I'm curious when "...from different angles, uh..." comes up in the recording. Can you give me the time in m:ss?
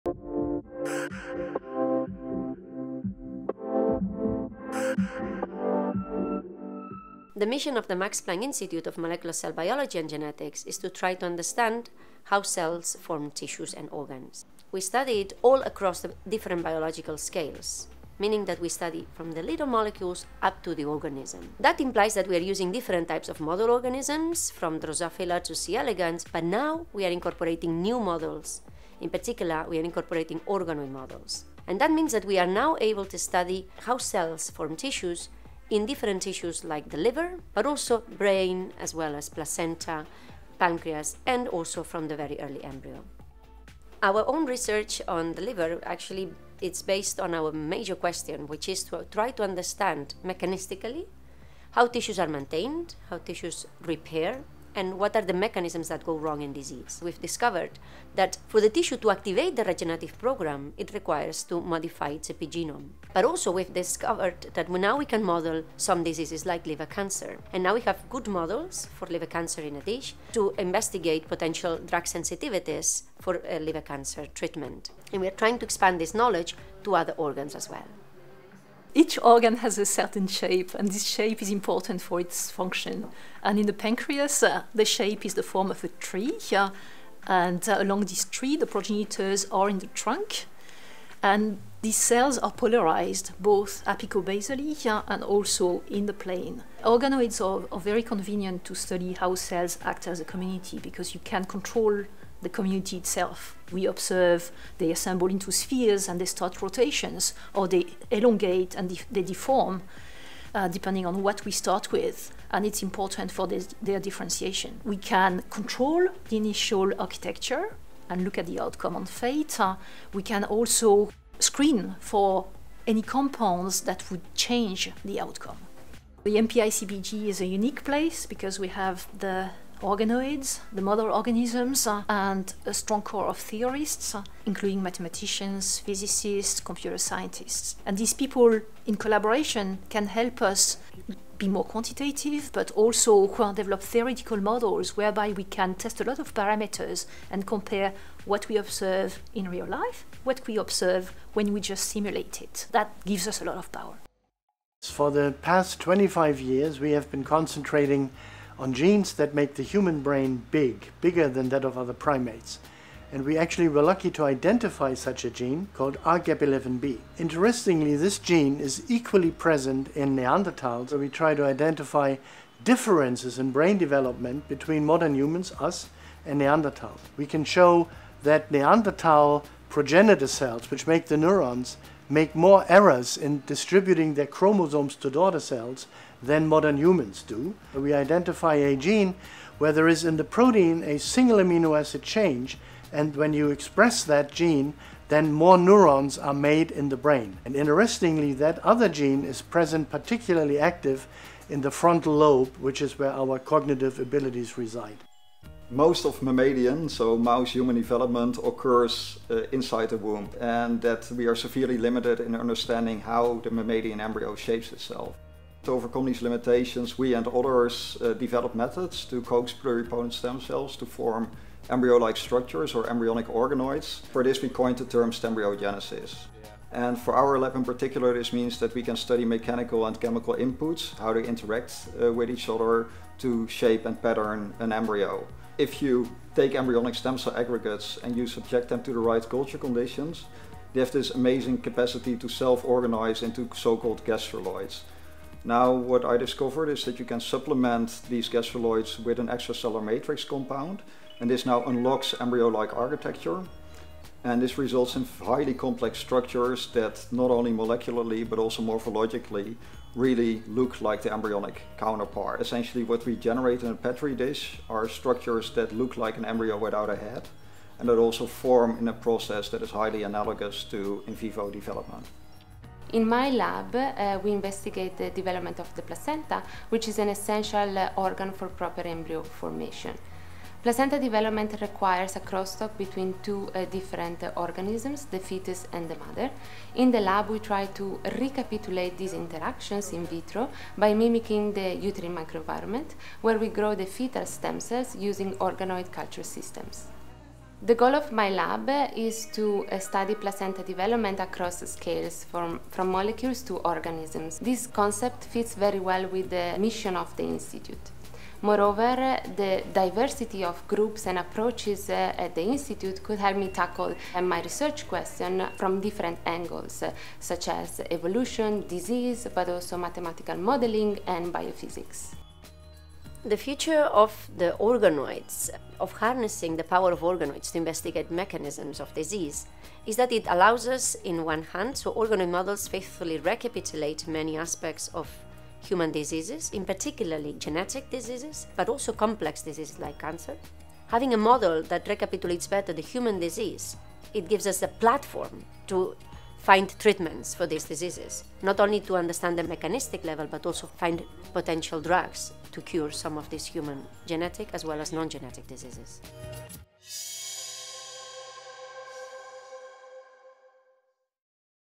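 5:15.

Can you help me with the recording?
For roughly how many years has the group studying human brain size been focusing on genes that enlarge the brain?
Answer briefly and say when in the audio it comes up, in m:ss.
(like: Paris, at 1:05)
25 years, at 2:35.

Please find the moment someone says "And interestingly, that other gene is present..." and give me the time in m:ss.
3:17.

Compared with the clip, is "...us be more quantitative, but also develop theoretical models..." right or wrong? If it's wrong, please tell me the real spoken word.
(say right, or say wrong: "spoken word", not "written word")
right.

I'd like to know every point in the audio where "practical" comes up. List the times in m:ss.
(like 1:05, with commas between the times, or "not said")
not said.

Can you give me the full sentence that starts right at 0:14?
We it all across the different biological scales, meaning that we study from the little molecules up to the organism.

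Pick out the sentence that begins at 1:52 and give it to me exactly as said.
And it's important for this, their differentiation.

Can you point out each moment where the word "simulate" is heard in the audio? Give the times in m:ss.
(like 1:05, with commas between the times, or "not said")
2:31.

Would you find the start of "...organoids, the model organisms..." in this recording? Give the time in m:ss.
2:09.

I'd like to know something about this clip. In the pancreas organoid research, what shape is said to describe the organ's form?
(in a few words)
a tree.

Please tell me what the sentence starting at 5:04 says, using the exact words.
This concept fits very well with the mission of the Institute.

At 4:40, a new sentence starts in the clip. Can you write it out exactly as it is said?
Placenta development requires a crosstalk between two uh, different uh, organisms, the fetus and the mother.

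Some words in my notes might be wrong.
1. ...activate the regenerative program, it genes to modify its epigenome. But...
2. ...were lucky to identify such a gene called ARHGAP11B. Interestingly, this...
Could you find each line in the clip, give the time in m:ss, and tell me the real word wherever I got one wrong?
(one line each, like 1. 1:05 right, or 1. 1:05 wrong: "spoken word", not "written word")
1. 0:59 wrong: "requires", not "genes"
2. 2:43 right.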